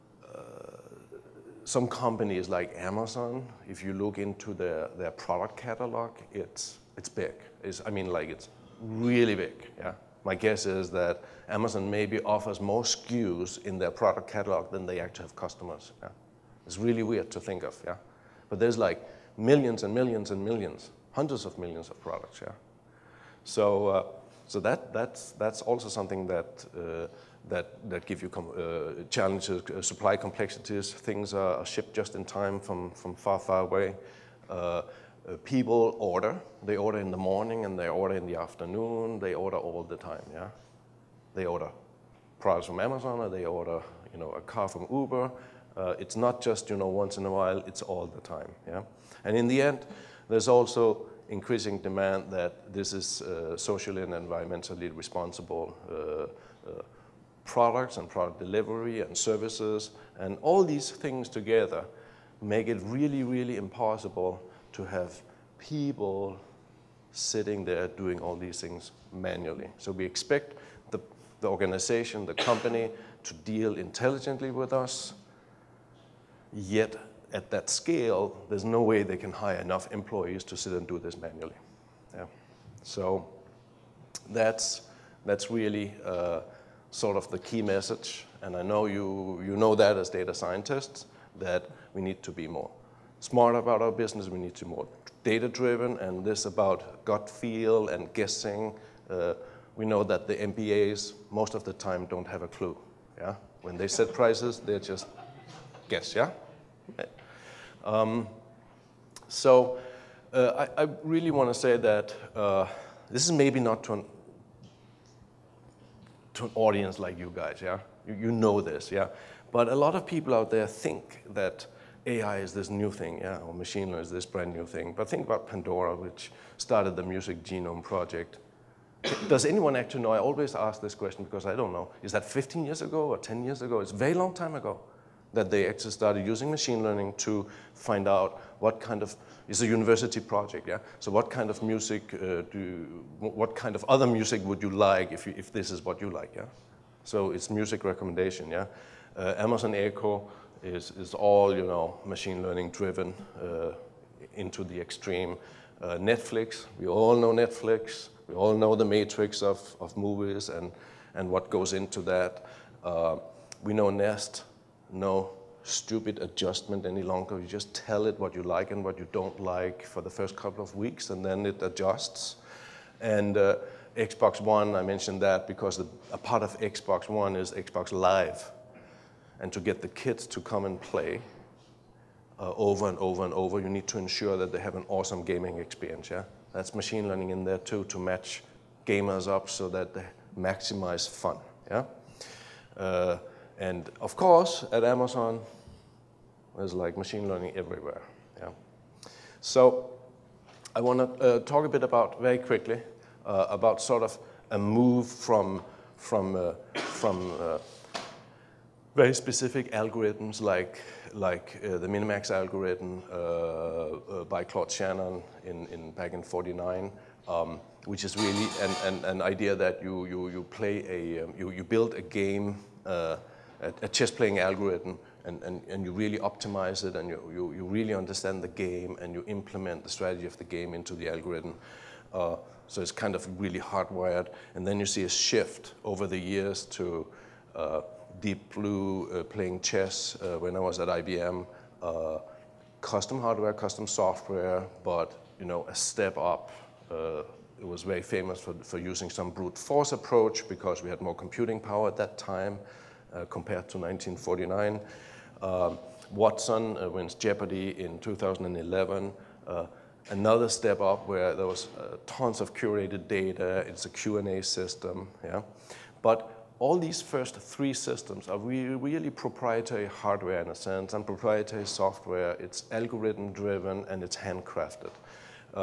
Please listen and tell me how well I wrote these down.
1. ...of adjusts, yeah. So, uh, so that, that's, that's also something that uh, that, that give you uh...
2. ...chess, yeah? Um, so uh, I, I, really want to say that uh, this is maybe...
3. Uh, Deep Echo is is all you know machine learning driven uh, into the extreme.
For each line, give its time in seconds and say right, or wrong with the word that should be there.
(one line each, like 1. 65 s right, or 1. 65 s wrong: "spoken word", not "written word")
1. 21 s wrong: "products", not "adjusts"
2. 105 s wrong: "guess", not "chess"
3. 149 s wrong: "Amazon", not "Deep".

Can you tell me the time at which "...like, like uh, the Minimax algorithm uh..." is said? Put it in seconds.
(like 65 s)
210 s.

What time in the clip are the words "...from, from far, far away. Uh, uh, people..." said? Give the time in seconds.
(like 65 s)
32 s.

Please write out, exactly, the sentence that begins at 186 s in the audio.
Yeah, that's machine learning in there too to match gamers up so that they maximize fun.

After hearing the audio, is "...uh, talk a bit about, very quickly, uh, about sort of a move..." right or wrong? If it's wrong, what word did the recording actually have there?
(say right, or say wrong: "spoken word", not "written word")
right.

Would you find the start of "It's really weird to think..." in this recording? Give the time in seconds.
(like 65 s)
16 s.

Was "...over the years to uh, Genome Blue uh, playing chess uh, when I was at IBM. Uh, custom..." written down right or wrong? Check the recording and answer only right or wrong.
wrong.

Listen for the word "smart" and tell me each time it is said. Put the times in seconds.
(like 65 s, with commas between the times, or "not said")
93 s.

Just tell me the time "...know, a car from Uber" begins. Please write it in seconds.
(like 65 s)
44 s.